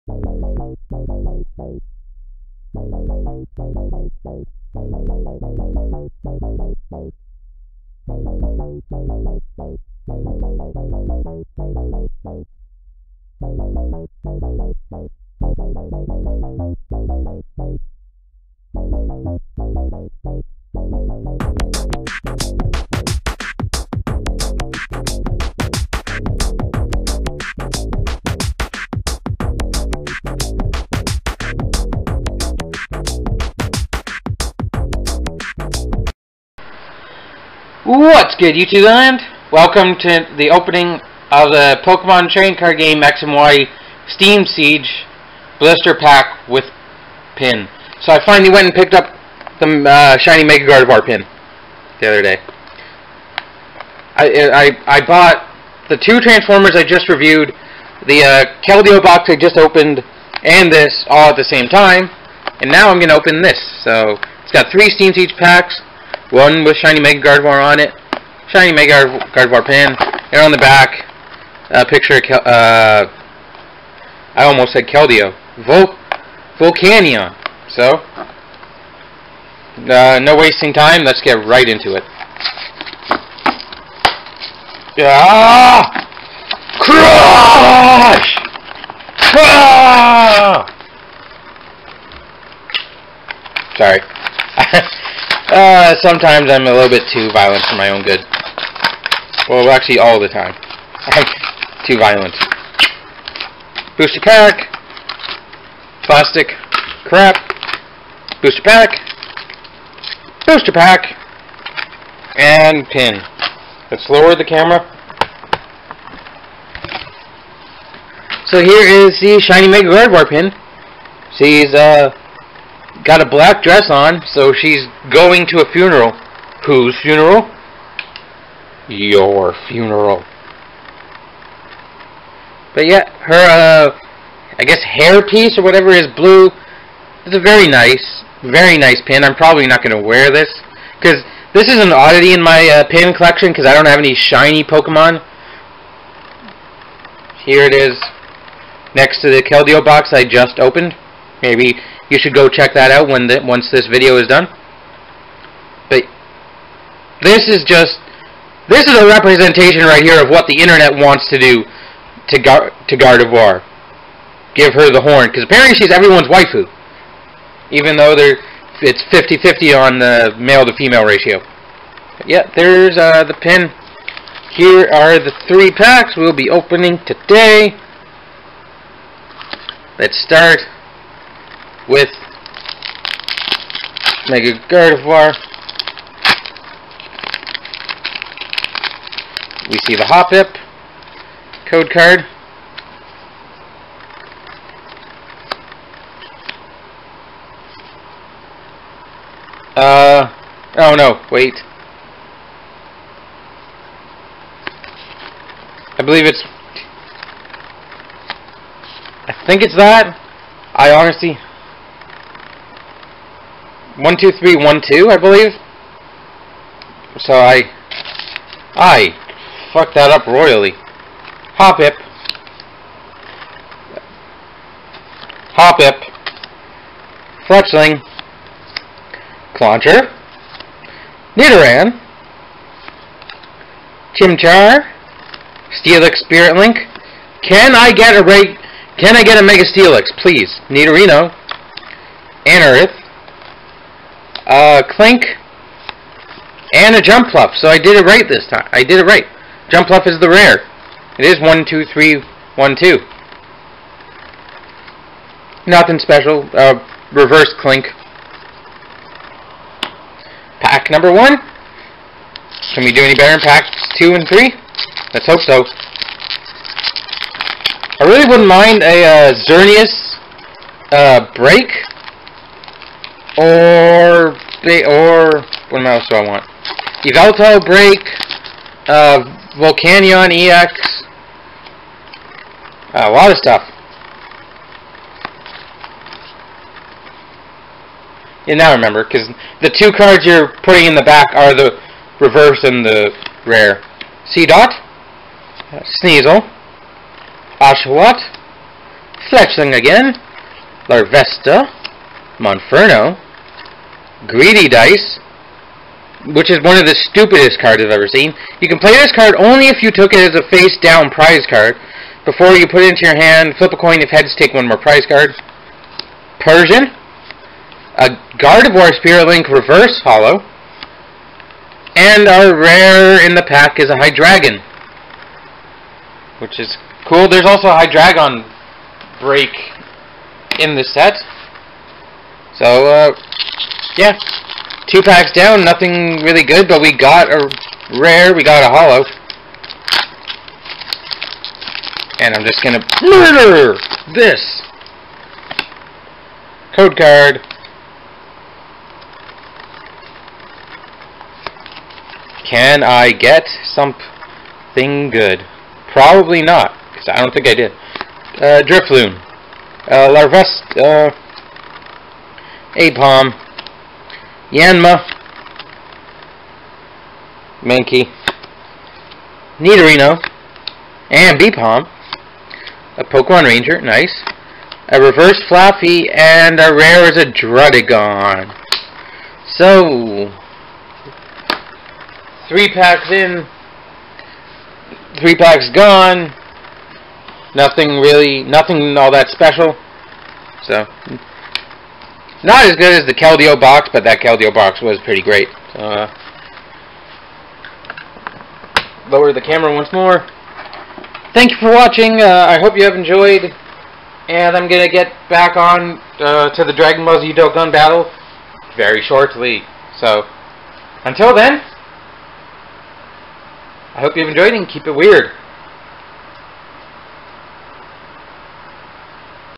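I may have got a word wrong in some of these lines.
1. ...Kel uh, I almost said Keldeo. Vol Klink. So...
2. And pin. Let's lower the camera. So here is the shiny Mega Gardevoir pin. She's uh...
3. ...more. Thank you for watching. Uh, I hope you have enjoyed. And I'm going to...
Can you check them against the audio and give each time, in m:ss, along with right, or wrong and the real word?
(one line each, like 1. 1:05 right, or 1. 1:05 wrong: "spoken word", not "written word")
1. 1:12 wrong: "Volcanion", not "Klink"
2. 1:52 right
3. 6:39 right.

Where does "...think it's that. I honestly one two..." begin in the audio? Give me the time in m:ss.
3:29.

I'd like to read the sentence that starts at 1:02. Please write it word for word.
And now I'm going to open this.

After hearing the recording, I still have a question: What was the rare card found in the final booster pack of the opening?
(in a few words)
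Druddigon.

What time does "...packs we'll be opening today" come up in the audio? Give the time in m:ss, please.
2:55.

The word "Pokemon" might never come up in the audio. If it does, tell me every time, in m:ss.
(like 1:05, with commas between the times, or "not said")
0:41, 2:24, 6:13.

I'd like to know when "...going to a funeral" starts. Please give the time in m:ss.
2:05.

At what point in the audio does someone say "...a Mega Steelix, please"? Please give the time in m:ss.
3:59.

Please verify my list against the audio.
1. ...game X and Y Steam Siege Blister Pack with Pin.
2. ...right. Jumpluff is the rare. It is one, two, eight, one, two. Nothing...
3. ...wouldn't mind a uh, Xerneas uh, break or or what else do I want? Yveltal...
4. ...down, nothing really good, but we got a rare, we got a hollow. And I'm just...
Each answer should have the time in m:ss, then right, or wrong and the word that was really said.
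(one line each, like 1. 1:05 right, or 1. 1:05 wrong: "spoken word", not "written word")
1. 0:42 right
2. 4:09 wrong: "three", not "eight"
3. 4:28 right
4. 5:35 right.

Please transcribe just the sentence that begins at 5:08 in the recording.
You can play this card only if you took it as a face-down prize card.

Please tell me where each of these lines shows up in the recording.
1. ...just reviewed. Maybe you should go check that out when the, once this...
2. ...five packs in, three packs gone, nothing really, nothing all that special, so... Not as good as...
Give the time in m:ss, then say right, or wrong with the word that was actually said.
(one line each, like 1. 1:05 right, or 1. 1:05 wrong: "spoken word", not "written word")
1. 2:30 wrong: "opened", not "reviewed"
2. 6:22 wrong: "three", not "five".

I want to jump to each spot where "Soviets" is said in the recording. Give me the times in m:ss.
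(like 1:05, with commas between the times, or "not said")
not said.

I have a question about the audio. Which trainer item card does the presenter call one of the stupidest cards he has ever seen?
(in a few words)
Greedy Dice.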